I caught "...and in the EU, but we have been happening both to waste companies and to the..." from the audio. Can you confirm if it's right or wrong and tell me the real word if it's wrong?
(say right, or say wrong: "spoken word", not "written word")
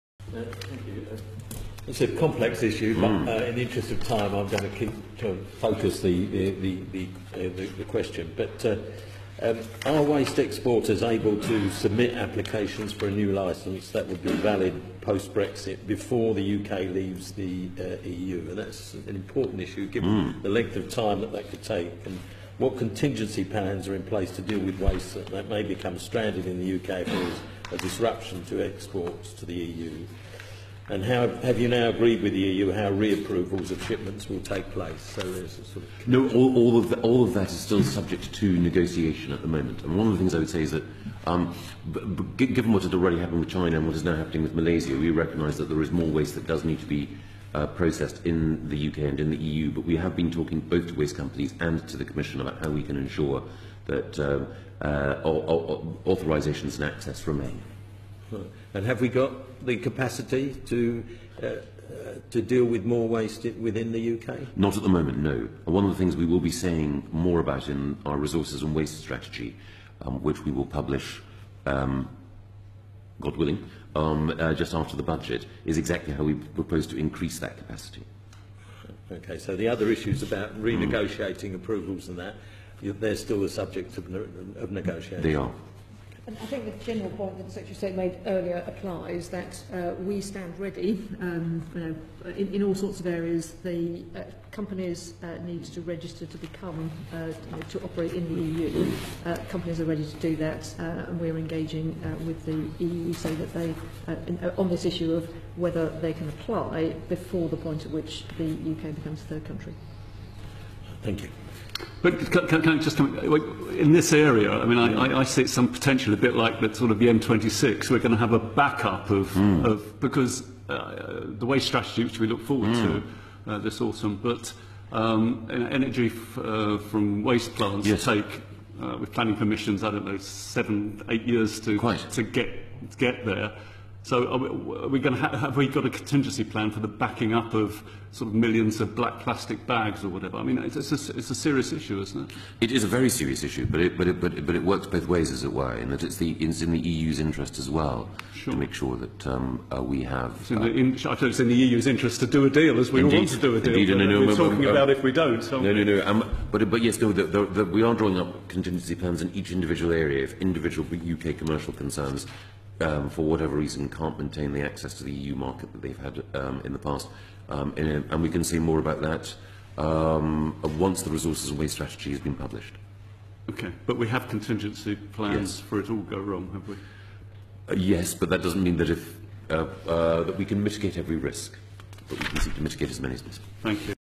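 wrong: "talking", not "happening".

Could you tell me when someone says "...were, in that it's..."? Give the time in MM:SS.
02:25.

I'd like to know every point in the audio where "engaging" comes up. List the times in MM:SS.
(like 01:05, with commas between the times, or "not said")
01:41.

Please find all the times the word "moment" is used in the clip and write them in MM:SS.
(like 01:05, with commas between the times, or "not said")
00:39, 01:04.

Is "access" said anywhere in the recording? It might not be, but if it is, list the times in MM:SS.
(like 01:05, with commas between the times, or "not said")
00:56, 02:44.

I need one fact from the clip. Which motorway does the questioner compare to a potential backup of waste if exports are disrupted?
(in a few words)
M26.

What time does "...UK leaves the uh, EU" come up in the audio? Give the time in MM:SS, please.
00:16.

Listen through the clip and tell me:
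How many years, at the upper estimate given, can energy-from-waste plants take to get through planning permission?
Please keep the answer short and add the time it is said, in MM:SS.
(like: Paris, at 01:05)
8, at 02:11.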